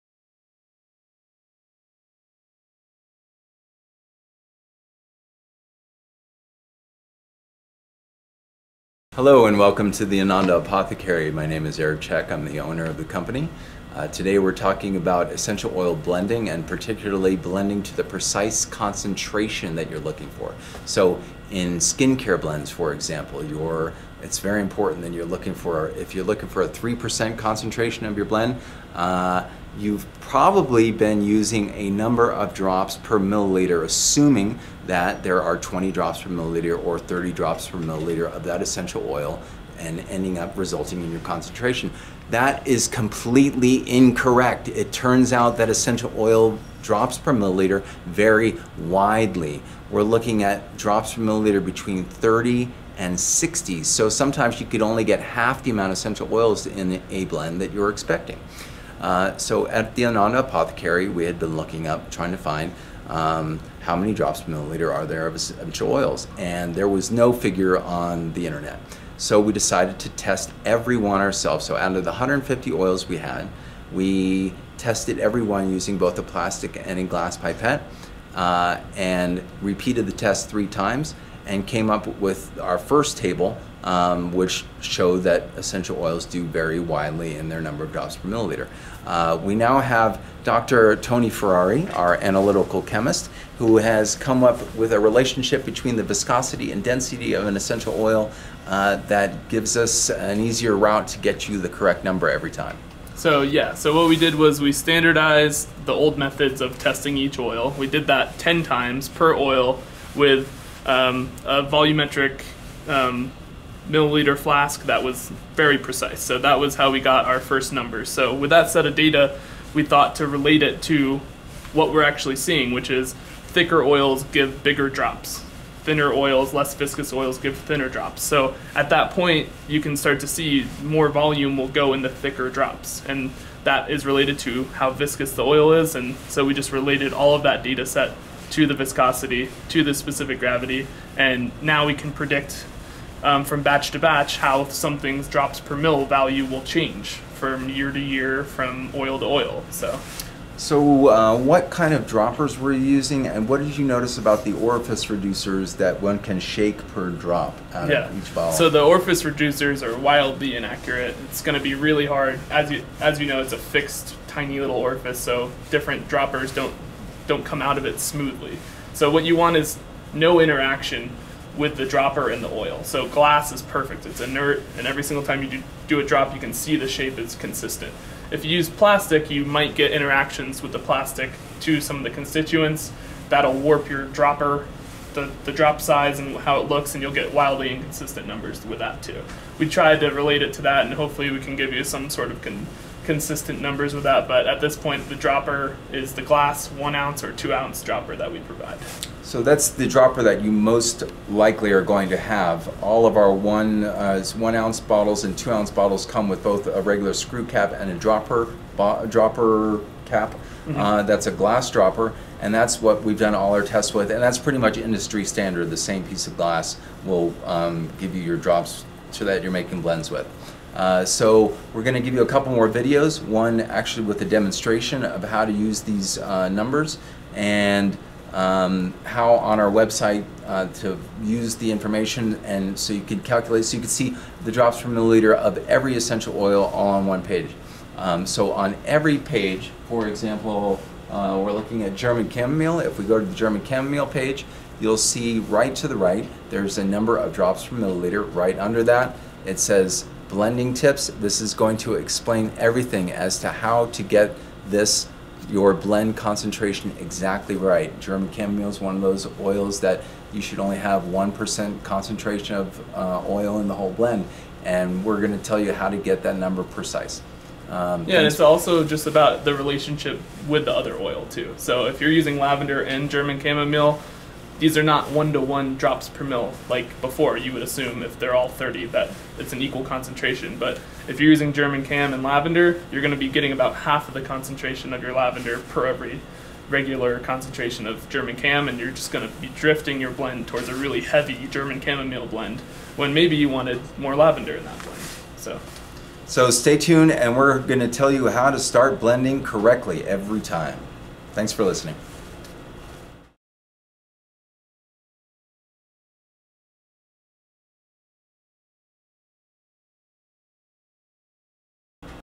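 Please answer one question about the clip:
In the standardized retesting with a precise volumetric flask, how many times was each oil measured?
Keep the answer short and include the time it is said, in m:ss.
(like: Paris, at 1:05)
10 times, at 1:48.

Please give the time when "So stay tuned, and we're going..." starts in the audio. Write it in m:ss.
4:56.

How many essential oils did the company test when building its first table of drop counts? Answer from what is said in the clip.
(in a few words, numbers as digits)
150.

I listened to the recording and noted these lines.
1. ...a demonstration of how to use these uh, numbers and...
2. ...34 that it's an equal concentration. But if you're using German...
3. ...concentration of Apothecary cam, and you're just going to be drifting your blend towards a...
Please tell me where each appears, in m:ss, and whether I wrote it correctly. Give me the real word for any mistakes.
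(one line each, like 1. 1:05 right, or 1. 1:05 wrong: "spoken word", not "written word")
1. 3:44 right
2. 4:38 wrong: "30", not "34"
3. 4:47 wrong: "German", not "Apothecary".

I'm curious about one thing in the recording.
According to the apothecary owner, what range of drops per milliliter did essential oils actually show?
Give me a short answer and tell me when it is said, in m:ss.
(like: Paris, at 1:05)
30 and 60, at 0:51.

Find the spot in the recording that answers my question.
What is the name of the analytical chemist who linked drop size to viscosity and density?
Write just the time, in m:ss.
1:30.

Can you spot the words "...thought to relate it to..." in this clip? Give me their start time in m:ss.
1:59.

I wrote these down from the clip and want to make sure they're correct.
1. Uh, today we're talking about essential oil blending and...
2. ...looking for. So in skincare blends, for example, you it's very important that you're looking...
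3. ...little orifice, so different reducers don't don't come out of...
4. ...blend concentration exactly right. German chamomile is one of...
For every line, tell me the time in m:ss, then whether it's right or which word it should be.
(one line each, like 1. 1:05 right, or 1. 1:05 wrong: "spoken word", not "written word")
1. 0:13 right
2. 0:19 right
3. 2:44 wrong: "droppers", not "reducers"
4. 4:15 right.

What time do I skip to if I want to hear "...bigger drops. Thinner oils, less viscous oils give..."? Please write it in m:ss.
2:04.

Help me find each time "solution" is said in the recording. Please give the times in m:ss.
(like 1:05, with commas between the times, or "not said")
not said.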